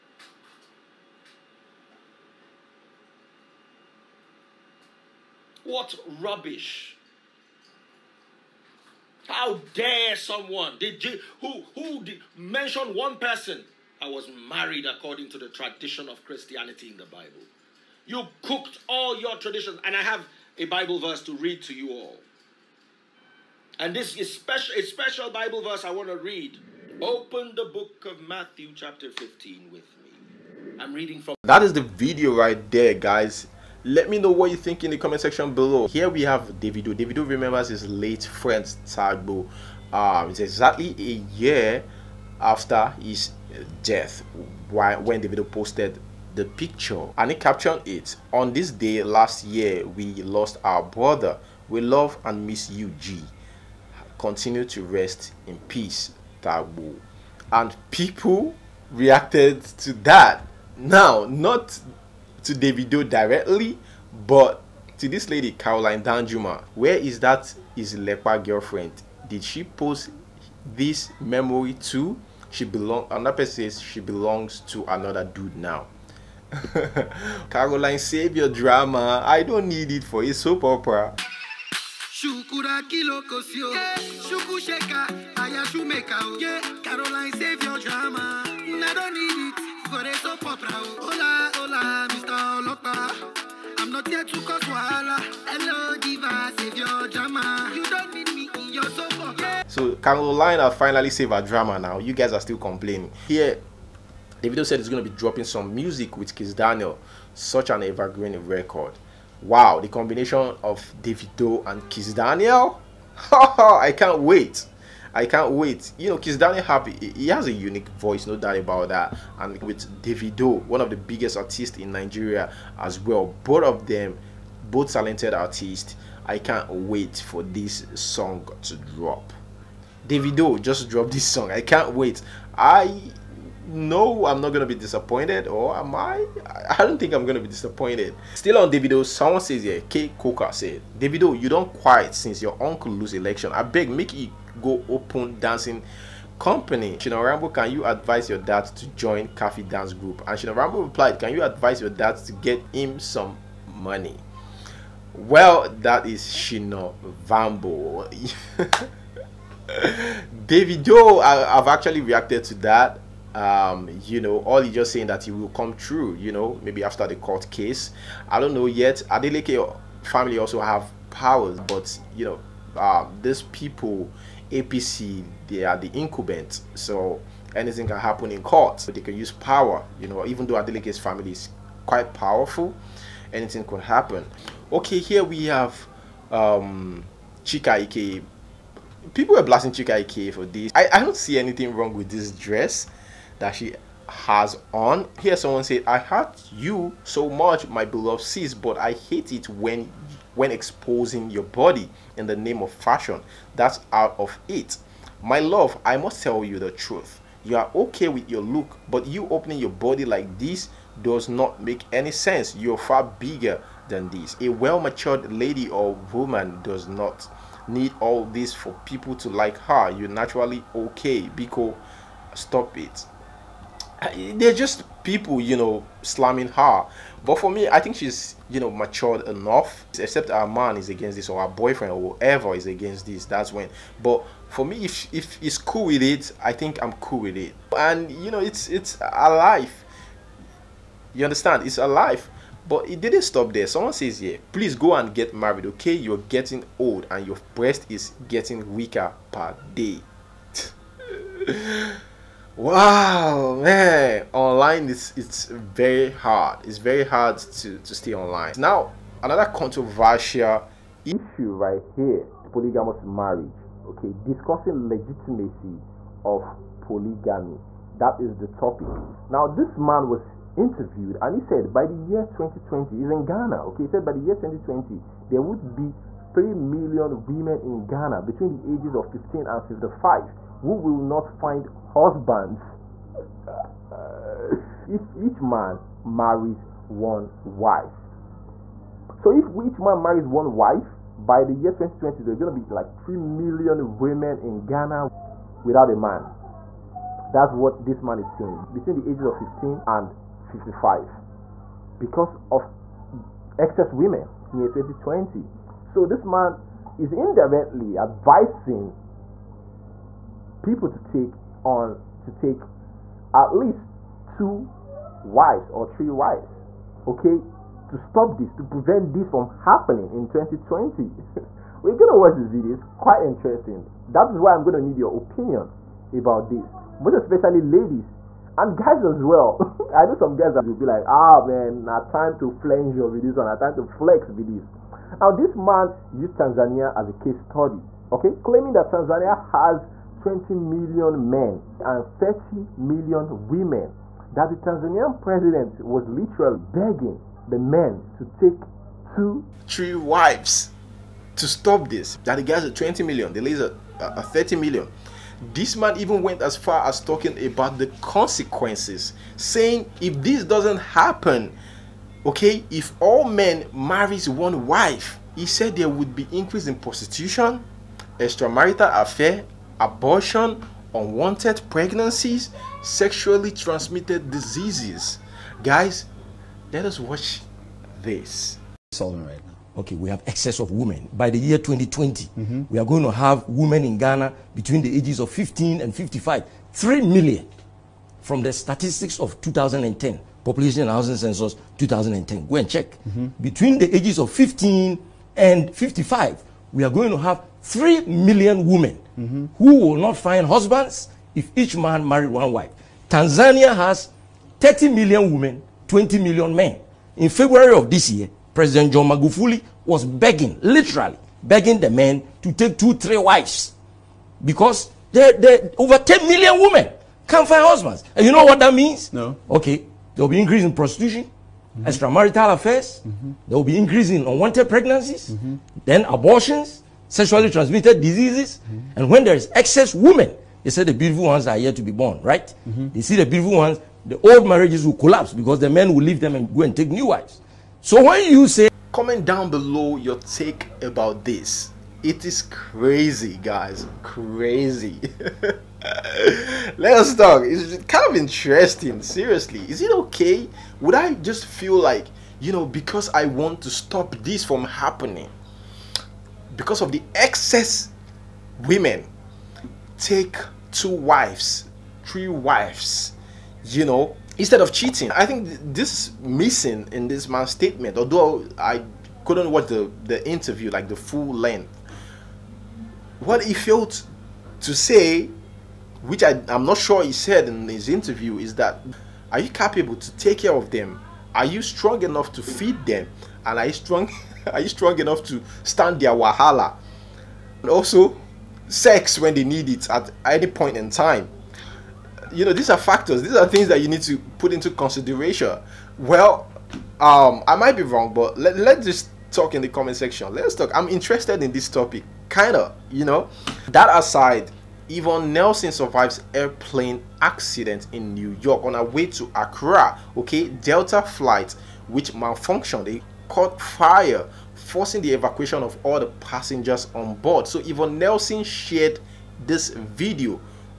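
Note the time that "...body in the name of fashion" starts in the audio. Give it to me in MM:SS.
03:21.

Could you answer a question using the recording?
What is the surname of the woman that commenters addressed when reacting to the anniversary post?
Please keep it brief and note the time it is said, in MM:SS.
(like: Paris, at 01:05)
Danjuma, at 01:06.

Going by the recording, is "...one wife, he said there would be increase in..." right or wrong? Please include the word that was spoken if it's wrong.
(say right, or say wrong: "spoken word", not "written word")
right.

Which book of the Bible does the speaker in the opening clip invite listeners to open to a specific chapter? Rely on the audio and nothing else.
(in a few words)
Matthew.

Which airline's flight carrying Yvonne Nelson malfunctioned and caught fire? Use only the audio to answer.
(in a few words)
Delta.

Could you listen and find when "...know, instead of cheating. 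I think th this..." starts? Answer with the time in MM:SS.
07:43.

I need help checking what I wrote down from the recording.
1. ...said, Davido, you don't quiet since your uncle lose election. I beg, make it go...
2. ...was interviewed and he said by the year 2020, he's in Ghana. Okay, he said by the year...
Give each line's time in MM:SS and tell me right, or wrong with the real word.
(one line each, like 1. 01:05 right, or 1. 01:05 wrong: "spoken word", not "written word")
1. 02:20 right
2. 04:30 right.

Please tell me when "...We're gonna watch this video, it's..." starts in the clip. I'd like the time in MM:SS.
05:21.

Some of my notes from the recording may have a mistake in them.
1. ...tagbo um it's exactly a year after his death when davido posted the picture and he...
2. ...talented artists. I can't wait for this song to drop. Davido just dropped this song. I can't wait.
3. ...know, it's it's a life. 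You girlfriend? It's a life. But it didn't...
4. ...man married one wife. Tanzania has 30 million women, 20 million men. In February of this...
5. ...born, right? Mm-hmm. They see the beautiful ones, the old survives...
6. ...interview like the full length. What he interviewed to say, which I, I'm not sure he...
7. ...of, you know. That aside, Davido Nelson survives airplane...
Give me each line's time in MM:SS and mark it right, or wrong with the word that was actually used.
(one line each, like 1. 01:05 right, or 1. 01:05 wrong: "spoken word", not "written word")
1. 00:38 right
2. 02:04 right
3. 03:58 wrong: "understand", not "girlfriend"
4. 06:41 right
5. 07:11 wrong: "marriages", not "survives"
6. 07:50 wrong: "failed", not "interviewed"
7. 08:22 wrong: "Yvonne", not "Davido".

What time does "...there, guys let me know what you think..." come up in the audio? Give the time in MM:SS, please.
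00:32.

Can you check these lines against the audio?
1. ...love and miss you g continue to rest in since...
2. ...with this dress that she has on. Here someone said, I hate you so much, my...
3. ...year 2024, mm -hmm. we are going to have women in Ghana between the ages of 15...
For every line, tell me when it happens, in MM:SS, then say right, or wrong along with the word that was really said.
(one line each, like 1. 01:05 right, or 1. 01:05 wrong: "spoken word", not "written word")
1. 00:51 wrong: "peace", not "since"
2. 03:11 right
3. 06:21 wrong: "2020", not "2024".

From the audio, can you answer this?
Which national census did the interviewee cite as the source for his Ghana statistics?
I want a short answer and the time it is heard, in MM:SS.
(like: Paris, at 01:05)
2010 population and housing census, at 06:30.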